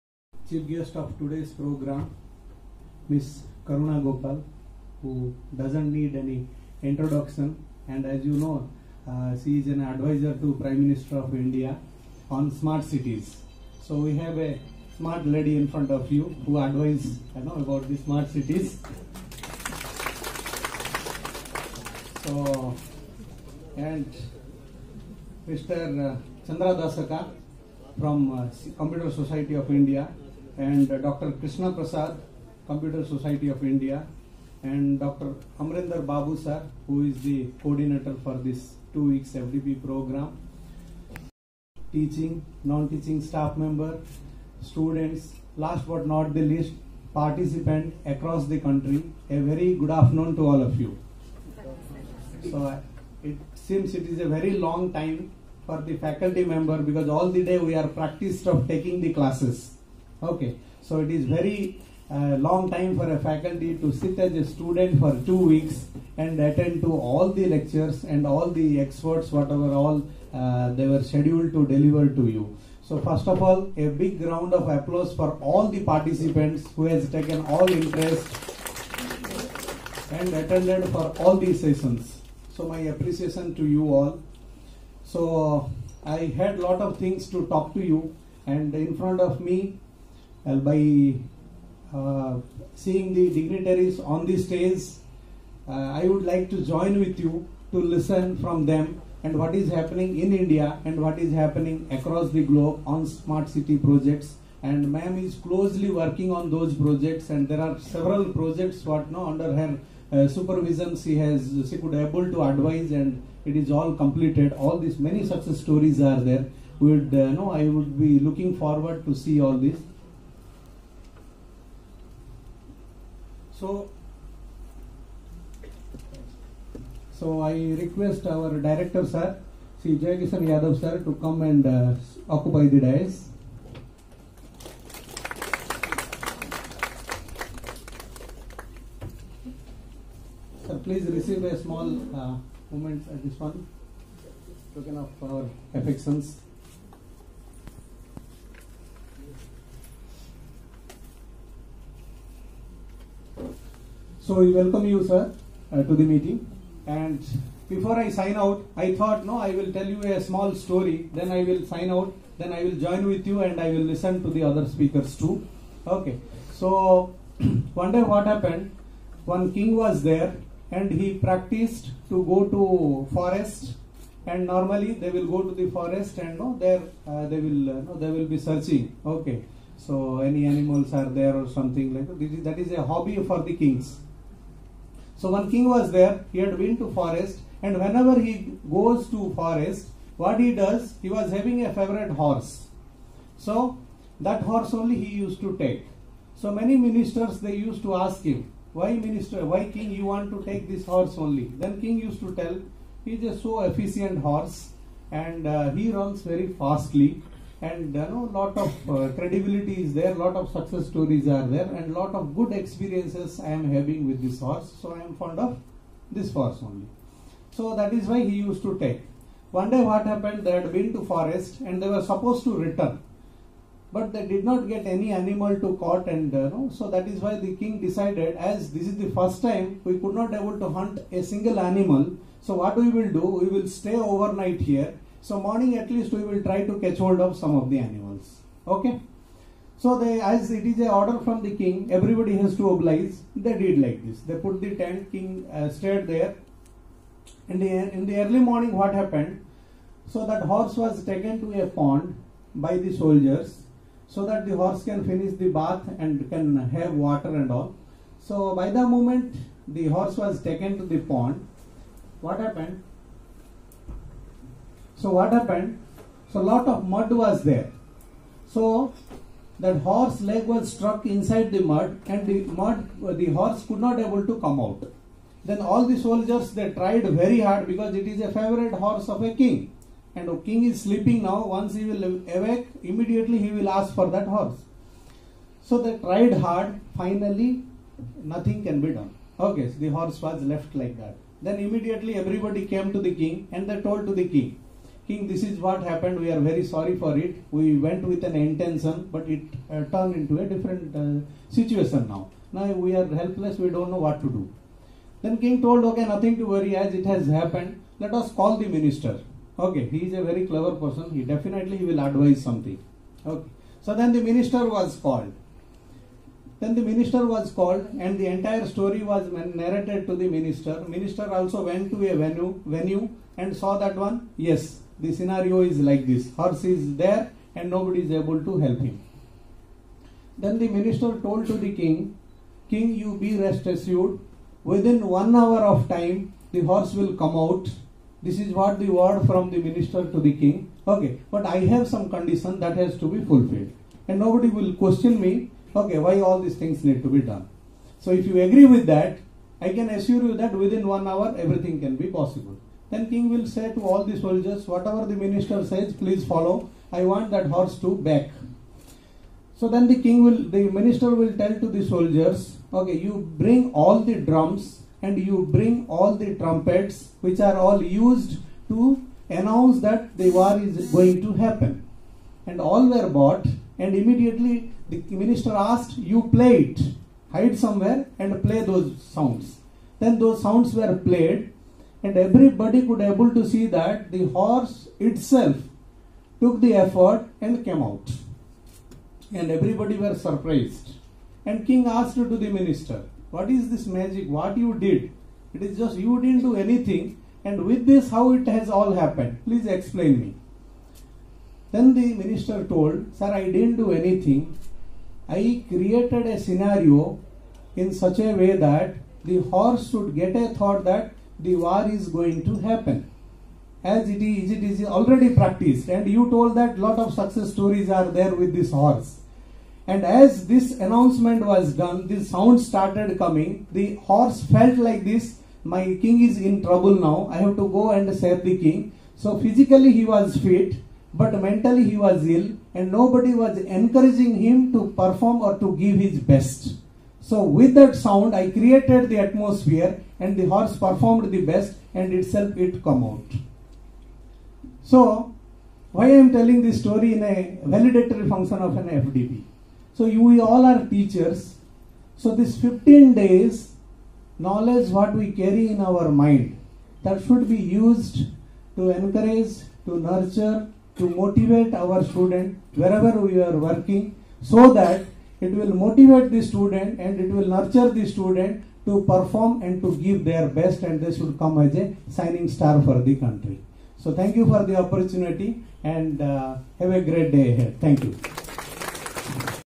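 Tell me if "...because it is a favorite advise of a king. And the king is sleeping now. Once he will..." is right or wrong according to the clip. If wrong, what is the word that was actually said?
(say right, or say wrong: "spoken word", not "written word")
wrong: "horse", not "advise".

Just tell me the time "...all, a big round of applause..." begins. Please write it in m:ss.
1:13.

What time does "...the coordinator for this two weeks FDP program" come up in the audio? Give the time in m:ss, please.
0:37.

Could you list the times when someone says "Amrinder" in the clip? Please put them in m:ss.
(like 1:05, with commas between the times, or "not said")
0:35.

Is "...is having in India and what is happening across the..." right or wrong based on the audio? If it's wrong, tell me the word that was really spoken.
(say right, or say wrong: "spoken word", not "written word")
wrong: "happening", not "having".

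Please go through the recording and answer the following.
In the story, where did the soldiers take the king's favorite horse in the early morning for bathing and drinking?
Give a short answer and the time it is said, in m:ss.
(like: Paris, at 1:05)
A pond, at 4:11.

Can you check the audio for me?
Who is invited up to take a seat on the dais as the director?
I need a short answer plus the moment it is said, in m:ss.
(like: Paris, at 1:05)
Sri Jayakisan Yadav, at 2:09.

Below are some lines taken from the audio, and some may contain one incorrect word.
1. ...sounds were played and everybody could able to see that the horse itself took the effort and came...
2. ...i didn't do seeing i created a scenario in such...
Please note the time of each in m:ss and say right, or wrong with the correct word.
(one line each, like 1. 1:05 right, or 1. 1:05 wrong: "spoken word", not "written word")
1. 6:20 right
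2. 6:43 wrong: "anything", not "seeing".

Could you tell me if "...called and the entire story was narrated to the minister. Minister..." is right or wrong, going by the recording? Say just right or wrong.
right.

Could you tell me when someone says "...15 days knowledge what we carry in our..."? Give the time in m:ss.
7:32.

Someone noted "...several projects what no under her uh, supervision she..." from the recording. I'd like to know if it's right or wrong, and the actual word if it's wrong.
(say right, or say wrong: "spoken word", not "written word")
right.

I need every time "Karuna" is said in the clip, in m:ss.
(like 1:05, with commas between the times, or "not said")
0:03.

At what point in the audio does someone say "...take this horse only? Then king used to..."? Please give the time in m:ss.
3:20.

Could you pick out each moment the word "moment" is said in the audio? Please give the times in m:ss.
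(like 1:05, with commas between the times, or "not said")
2:22, 4:18.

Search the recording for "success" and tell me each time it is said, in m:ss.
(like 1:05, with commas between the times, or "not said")
1:55, 3:30, 6:57.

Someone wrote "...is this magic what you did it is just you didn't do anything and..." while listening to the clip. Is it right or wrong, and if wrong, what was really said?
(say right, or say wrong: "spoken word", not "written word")
right.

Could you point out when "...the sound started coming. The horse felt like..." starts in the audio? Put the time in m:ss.
7:02.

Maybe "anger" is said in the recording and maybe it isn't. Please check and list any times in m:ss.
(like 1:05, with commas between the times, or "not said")
not said.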